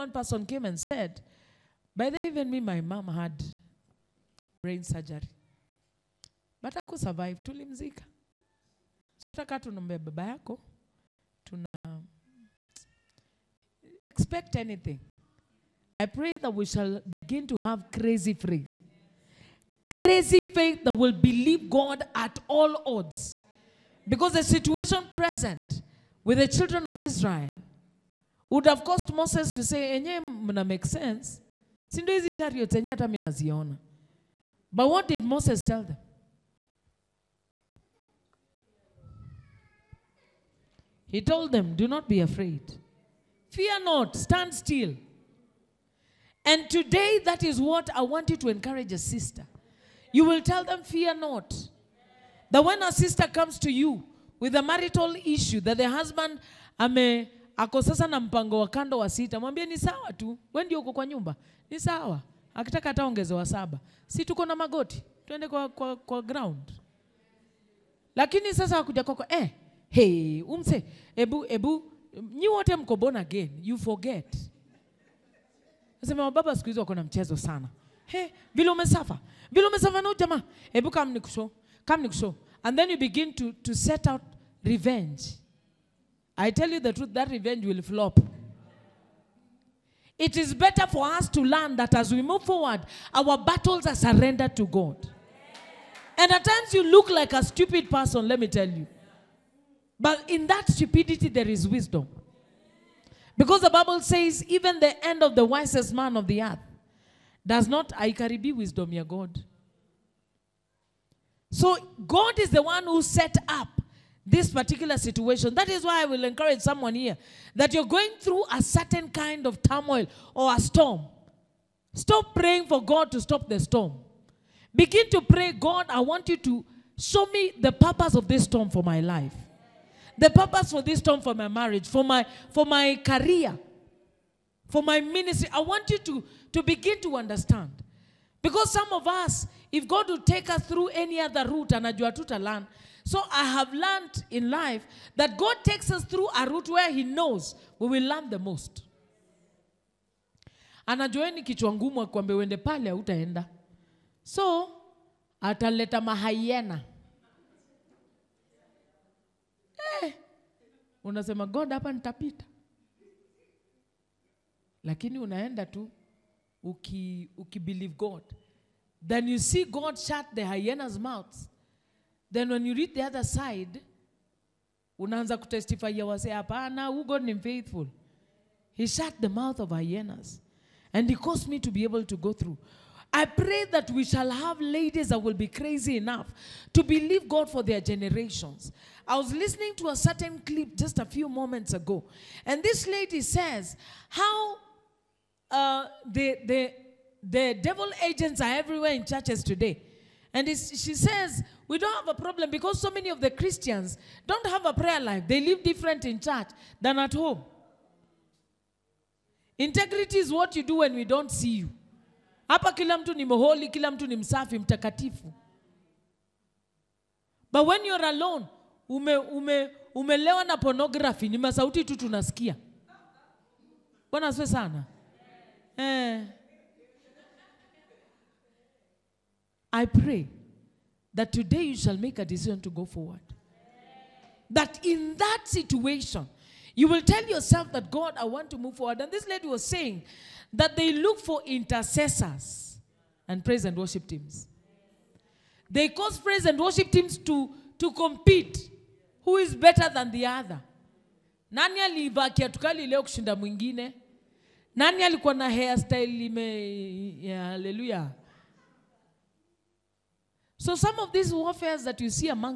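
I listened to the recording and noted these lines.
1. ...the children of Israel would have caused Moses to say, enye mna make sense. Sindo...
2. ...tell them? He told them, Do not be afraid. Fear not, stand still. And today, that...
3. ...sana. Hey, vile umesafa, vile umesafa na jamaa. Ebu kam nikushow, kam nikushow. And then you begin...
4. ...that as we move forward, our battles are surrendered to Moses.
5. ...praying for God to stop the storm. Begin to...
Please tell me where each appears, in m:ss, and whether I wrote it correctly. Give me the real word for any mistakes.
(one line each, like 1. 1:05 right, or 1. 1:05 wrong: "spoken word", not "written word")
1. 0:26 right
2. 0:35 right
3. 1:17 right
4. 1:31 wrong: "God", not "Moses"
5. 2:02 right.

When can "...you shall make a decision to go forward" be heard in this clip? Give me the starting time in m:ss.
3:51.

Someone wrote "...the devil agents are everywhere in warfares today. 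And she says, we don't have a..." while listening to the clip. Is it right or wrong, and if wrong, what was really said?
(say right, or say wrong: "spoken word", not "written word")
wrong: "churches", not "warfares".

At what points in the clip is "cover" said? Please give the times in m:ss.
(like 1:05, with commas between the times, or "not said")
not said.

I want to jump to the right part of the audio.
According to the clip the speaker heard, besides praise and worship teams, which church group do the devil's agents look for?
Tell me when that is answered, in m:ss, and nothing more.
4:01.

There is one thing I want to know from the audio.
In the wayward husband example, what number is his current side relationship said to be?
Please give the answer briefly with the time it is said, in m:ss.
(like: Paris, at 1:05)
6, at 0:59.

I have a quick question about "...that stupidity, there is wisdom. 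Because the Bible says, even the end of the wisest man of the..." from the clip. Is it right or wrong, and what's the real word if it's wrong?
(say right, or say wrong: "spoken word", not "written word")
right.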